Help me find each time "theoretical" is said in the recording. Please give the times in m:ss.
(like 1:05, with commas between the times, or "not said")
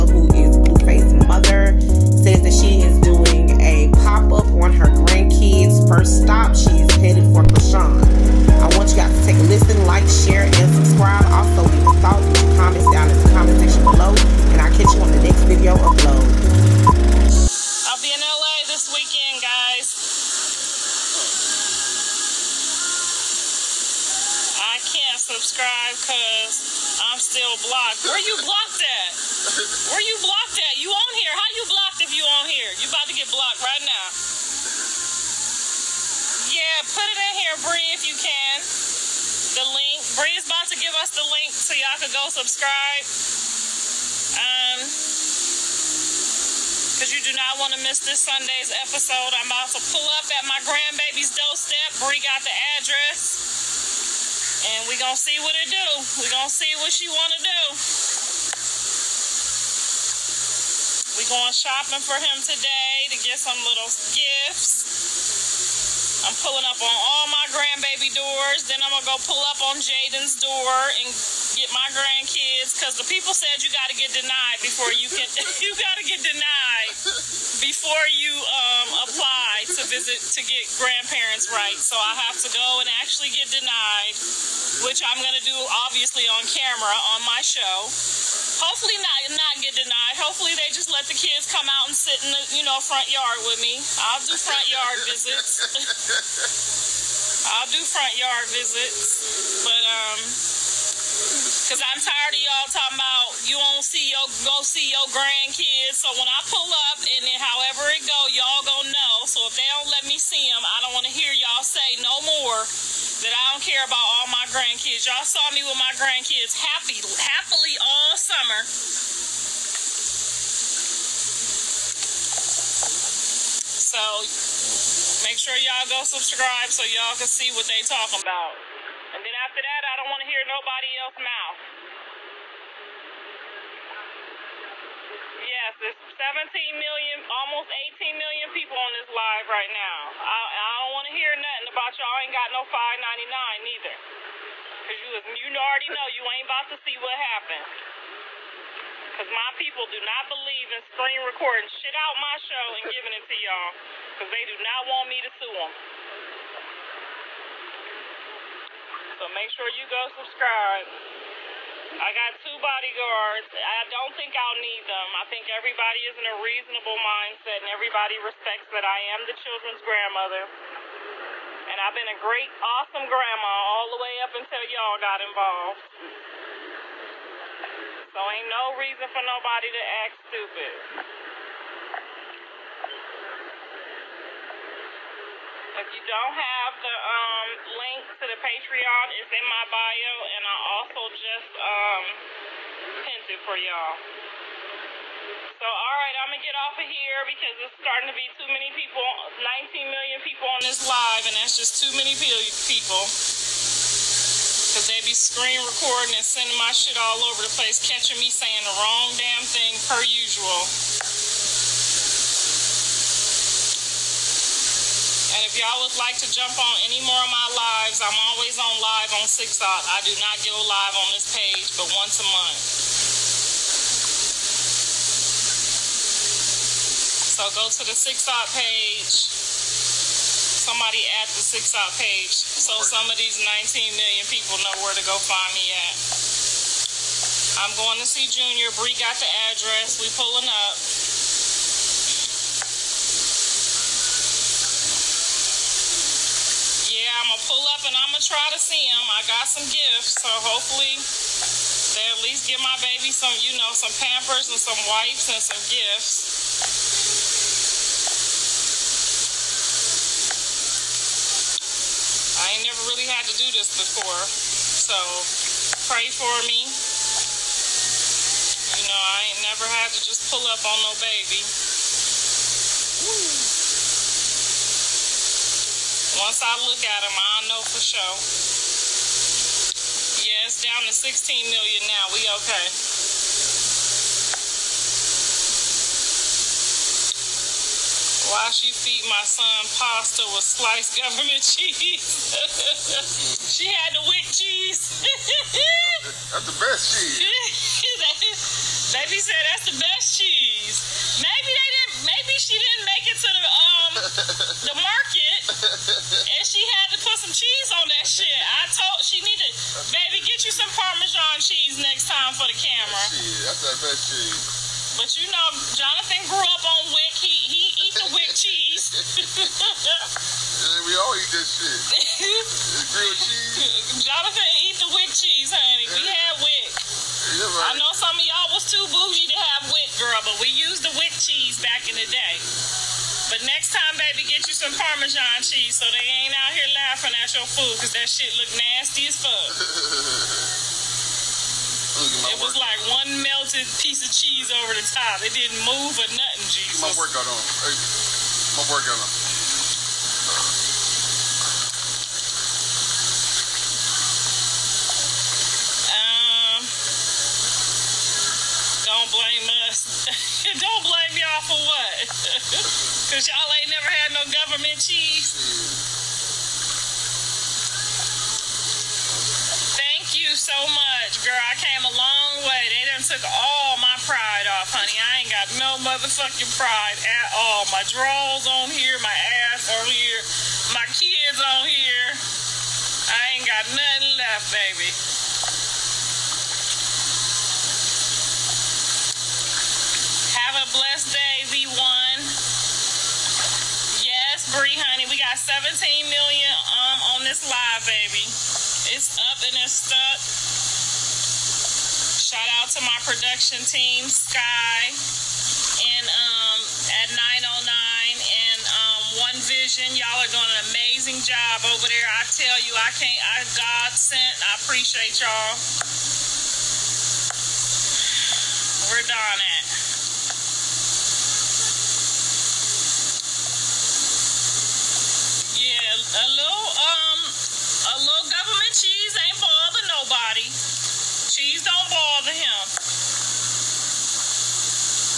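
not said.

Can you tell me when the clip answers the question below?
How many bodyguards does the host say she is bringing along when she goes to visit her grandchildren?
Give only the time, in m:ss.
2:42.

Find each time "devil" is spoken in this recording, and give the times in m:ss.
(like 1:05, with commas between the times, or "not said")
not said.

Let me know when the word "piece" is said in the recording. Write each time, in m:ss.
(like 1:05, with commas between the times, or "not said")
5:43.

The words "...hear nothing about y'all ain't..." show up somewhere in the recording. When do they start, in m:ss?
2:21.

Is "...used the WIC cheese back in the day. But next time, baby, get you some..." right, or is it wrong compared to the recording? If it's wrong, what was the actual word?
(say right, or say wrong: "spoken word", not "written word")
right.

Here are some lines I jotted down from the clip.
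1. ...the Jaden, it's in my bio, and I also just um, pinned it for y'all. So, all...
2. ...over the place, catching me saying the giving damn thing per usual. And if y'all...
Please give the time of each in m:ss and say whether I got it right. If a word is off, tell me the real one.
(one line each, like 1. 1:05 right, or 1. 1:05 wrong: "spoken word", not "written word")
1. 3:08 wrong: "Patreon", not "Jaden"
2. 3:27 wrong: "wrong", not "giving".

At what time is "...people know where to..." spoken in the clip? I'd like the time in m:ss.
3:54.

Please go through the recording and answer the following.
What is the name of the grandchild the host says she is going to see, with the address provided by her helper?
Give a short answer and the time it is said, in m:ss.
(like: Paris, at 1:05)
Junior, at 3:58.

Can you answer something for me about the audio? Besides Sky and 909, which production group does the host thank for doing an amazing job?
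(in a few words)
One Vision.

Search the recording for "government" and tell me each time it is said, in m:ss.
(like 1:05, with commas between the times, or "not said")
4:50, 6:04, 7:08.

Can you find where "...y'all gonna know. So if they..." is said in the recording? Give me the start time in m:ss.
1:48.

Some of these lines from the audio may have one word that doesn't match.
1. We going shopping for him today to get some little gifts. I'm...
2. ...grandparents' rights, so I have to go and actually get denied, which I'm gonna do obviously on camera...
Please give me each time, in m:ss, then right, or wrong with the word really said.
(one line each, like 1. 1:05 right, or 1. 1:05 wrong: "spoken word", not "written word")
1. 1:01 right
2. 1:20 right.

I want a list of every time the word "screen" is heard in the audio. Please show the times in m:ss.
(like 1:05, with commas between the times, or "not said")
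2:30, 3:25.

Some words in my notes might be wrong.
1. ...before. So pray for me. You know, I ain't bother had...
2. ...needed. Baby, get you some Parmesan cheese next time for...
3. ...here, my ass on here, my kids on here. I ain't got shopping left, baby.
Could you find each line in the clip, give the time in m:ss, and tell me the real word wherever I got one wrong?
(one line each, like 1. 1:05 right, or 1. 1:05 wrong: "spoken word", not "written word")
1. 4:23 wrong: "never", not "bother"
2. 5:09 right
3. 6:18 wrong: "nothing", not "shopping".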